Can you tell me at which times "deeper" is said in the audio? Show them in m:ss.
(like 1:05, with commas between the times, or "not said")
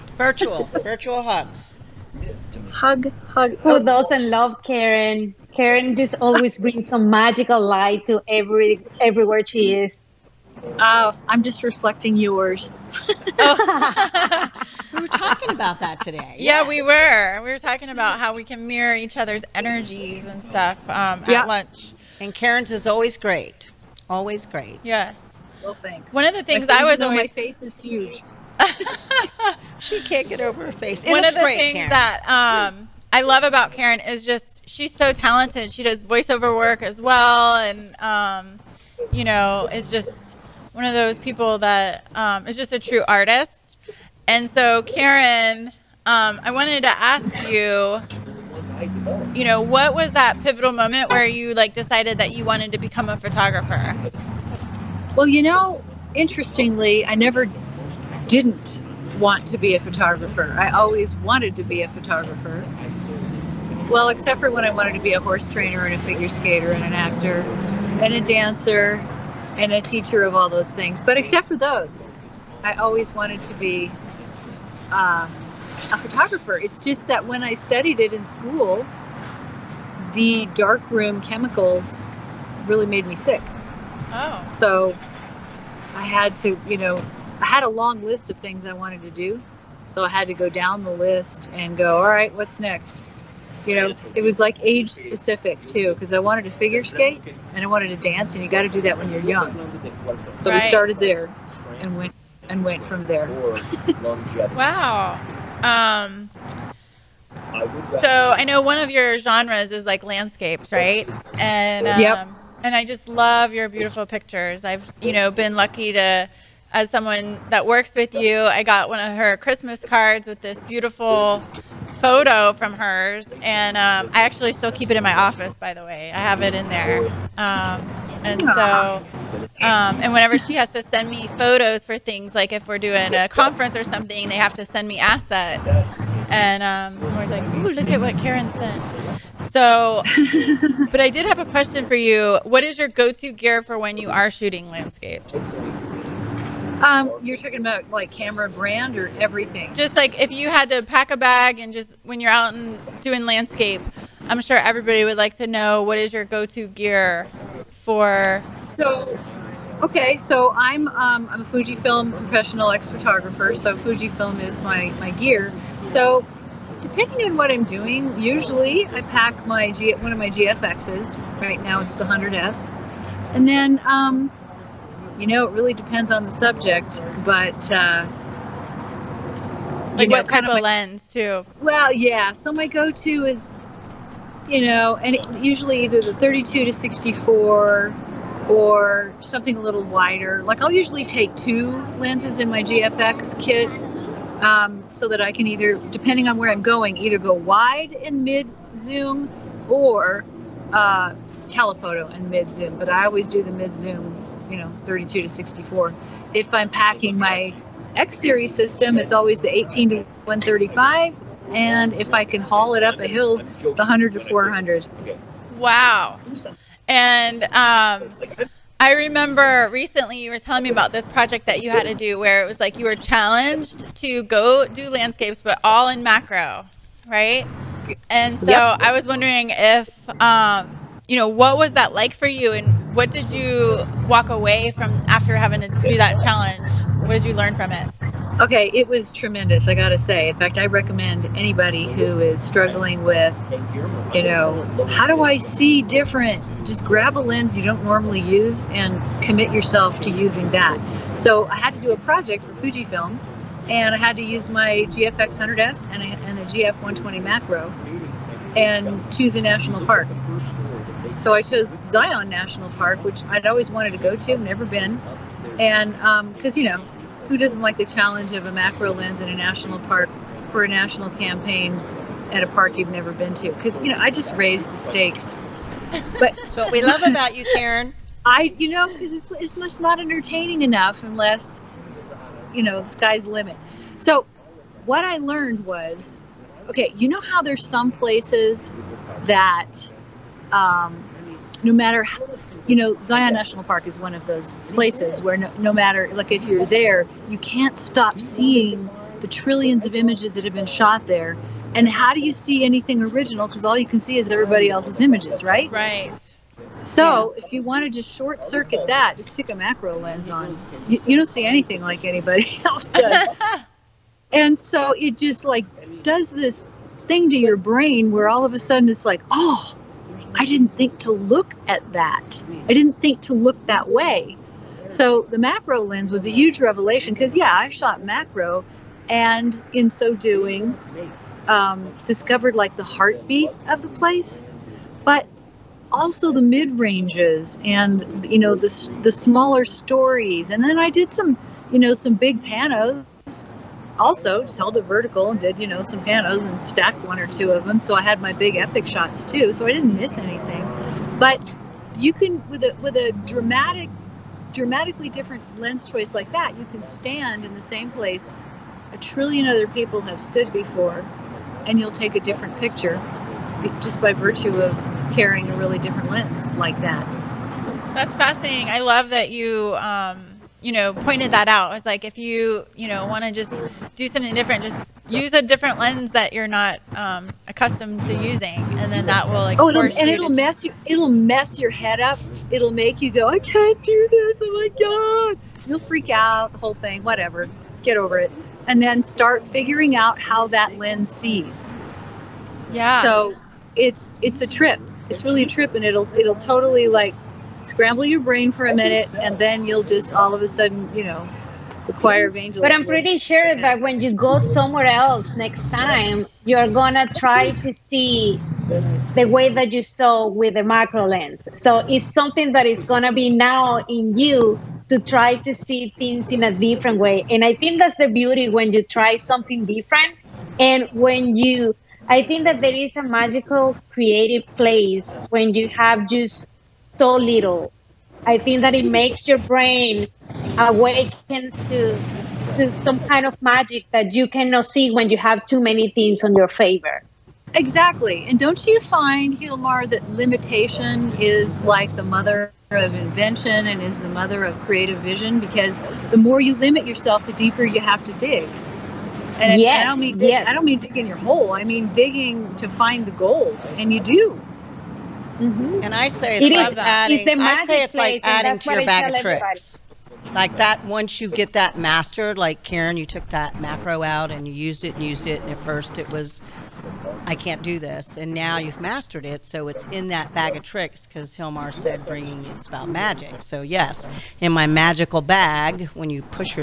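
7:27.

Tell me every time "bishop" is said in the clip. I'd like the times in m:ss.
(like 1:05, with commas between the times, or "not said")
not said.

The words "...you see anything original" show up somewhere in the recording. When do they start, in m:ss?
5:02.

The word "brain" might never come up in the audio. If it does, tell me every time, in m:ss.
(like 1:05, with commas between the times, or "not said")
5:17, 6:38, 7:09.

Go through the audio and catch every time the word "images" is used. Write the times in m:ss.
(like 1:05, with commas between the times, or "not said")
4:59, 5:05.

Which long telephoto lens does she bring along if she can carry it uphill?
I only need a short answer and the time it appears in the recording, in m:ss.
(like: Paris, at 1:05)
100 to 400, at 3:33.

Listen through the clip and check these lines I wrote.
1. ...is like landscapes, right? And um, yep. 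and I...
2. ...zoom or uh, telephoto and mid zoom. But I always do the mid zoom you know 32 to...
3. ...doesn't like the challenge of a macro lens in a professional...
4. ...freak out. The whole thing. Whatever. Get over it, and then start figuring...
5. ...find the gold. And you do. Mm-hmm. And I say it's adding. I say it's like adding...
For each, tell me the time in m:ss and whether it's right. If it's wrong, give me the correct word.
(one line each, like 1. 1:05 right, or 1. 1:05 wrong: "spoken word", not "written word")
1. 1:49 right
2. 3:18 right
3. 4:27 wrong: "national", not "professional"
4. 6:25 right
5. 7:32 right.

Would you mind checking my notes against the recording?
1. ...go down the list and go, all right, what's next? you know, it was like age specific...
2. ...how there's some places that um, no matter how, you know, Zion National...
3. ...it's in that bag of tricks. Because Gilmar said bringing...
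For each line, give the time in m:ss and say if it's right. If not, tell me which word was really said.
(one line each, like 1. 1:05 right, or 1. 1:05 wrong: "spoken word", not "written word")
1. 1:30 right
2. 4:47 right
3. 7:49 right.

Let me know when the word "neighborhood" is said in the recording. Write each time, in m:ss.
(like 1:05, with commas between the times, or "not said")
not said.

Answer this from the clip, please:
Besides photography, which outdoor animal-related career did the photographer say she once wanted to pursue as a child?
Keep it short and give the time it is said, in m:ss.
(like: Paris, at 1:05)
Horse trainer, at 1:05.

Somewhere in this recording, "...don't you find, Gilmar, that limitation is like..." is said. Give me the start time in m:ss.
7:18.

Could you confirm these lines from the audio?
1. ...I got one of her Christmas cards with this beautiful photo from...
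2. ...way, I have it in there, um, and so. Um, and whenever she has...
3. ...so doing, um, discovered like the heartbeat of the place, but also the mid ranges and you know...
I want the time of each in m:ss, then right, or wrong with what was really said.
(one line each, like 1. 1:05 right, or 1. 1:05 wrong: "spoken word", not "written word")
1. 1:58 right
2. 2:05 right
3. 5:29 right.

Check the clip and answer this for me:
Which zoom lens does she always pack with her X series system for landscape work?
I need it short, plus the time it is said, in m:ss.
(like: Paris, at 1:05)
18 to 135, at 3:29.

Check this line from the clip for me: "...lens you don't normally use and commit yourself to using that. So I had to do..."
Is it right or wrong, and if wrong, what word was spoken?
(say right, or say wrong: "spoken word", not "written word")
right.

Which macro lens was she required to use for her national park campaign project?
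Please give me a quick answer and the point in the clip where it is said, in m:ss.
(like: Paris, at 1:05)
GF 120 macro, at 4:16.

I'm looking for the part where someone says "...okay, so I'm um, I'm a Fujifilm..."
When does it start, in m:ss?
2:39.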